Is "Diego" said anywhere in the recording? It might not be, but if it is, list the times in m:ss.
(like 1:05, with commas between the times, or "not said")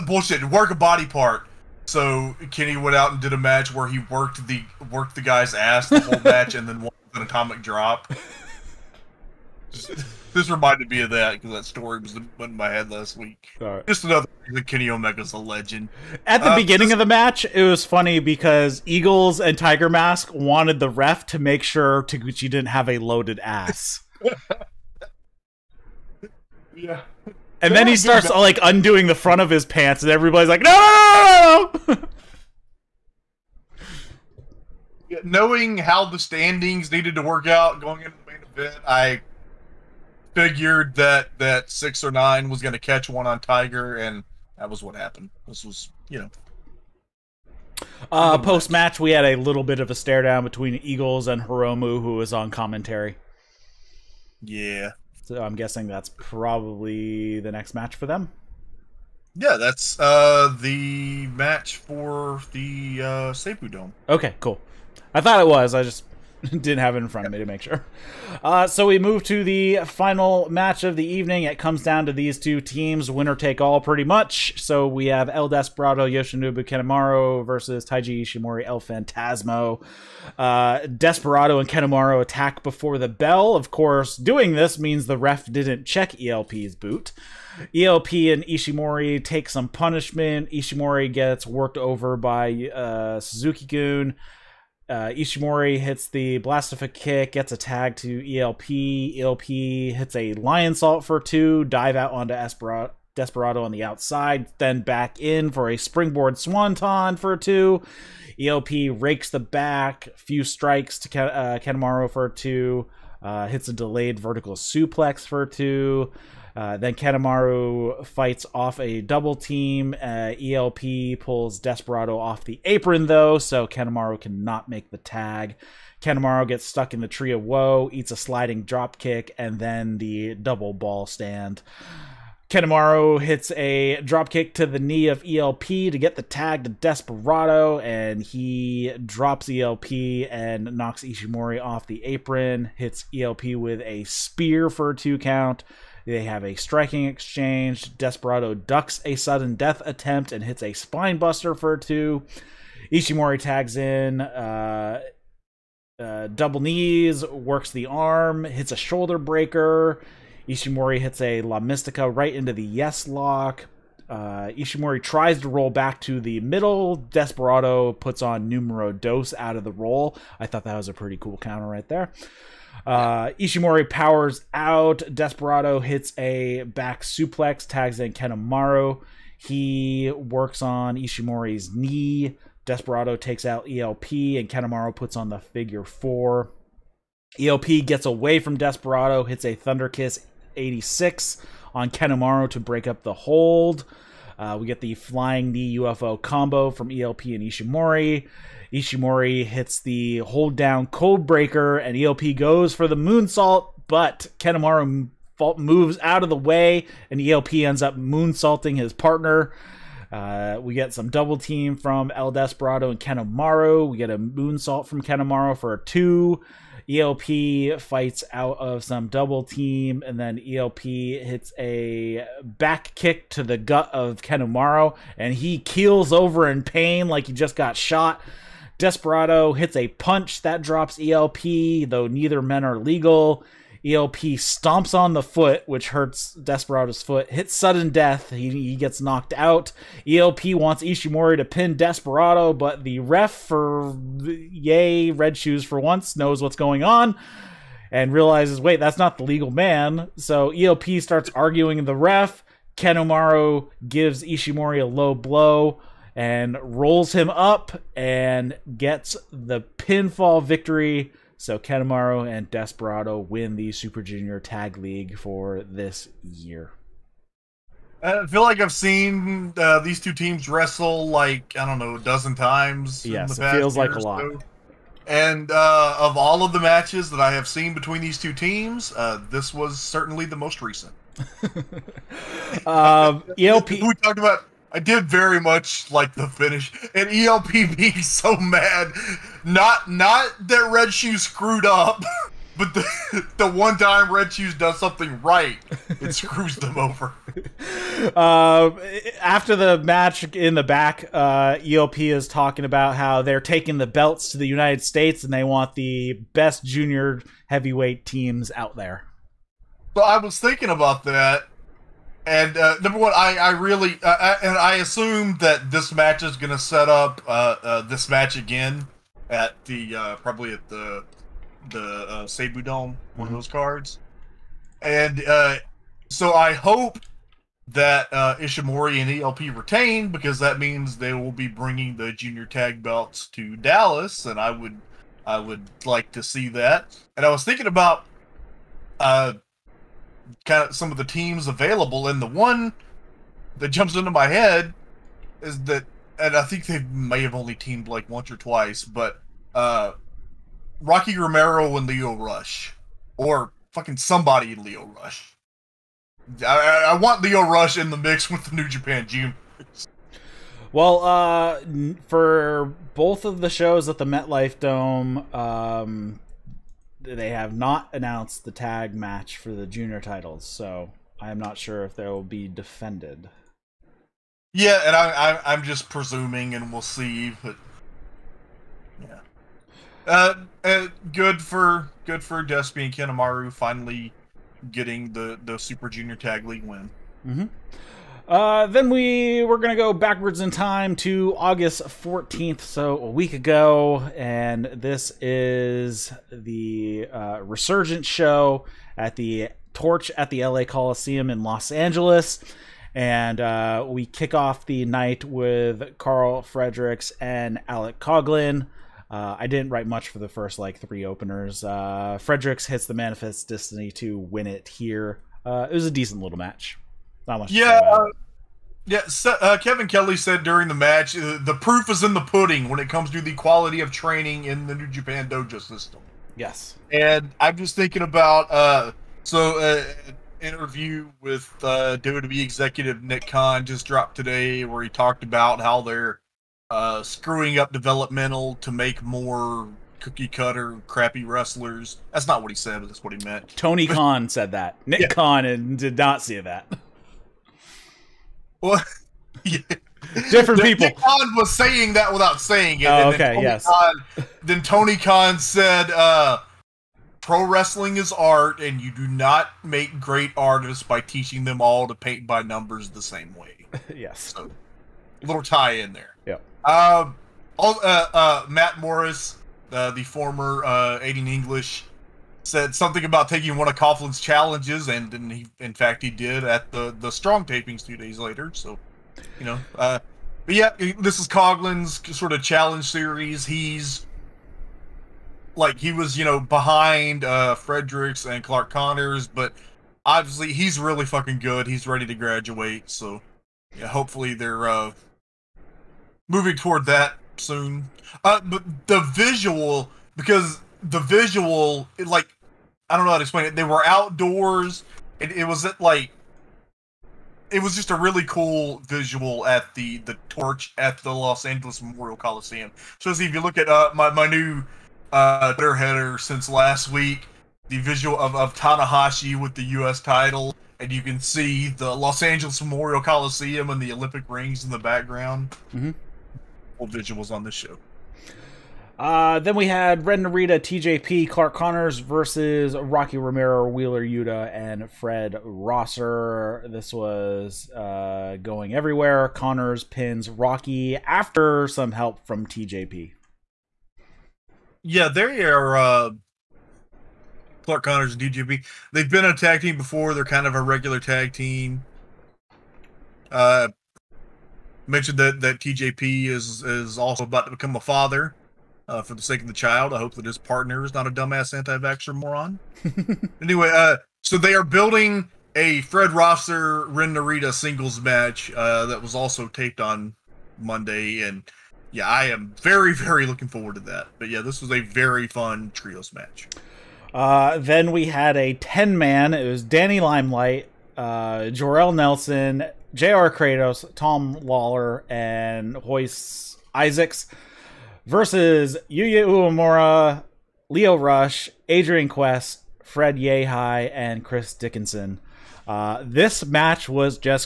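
not said.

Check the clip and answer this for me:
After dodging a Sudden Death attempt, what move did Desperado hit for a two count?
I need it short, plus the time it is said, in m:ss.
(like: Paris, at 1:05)
Spinebuster, at 2:30.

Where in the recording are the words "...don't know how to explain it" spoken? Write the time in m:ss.
8:22.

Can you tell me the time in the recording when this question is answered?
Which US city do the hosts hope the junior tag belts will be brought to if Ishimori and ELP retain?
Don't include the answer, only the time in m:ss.
5:33.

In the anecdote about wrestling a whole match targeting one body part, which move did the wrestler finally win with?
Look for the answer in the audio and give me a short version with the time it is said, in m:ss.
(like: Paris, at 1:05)
Atomic drop, at 0:07.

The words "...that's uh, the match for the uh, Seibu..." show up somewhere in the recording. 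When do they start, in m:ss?
0:59.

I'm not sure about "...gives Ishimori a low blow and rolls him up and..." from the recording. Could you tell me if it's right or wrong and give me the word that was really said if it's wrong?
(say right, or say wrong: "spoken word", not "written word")
right.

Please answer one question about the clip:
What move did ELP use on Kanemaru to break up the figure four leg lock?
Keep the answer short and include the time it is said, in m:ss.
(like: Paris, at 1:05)
Thunder Kiss 86, at 3:09.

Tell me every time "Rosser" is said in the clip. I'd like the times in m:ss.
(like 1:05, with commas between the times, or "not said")
8:55, 9:26.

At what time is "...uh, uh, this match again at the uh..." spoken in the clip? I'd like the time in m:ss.
5:17.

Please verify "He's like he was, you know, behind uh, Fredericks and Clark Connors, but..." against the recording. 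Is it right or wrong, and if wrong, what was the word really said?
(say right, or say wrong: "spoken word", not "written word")
right.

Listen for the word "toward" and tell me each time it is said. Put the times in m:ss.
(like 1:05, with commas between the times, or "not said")
8:16.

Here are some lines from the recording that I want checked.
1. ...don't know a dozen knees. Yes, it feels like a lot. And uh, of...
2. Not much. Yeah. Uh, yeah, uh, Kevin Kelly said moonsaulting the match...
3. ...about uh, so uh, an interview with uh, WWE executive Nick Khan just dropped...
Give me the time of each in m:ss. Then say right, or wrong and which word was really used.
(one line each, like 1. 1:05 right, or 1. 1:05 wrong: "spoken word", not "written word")
1. 4:31 wrong: "times", not "knees"
2. 6:57 wrong: "during", not "moonsaulting"
3. 7:08 right.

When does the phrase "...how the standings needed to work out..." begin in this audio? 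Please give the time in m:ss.
0:35.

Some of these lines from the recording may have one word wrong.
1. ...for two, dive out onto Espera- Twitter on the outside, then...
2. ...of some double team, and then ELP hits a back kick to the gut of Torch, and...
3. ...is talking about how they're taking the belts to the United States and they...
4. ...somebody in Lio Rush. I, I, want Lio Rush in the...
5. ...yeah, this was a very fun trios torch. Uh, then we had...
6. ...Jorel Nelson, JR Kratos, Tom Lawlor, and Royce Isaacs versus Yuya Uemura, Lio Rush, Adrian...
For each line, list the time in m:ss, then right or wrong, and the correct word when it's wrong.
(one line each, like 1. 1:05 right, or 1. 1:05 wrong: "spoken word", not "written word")
1. 1:41 wrong: "Desperado", not "Twitter"
2. 3:38 wrong: "Kanemaru", not "Torch"
3. 5:01 right
4. 5:53 right
5. 9:34 wrong: "match", not "torch"
6. 9:41 right.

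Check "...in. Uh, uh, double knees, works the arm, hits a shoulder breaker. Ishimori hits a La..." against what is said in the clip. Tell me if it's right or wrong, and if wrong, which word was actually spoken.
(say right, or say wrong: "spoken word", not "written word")
right.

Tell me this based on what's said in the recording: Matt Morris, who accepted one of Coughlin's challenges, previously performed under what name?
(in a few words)
Aiden English.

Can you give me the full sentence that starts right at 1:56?
Uh, then Kanemaru fights off a double team.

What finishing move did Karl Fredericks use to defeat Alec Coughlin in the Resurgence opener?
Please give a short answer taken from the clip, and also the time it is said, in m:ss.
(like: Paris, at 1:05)
Manifest Destiny, at 6:52.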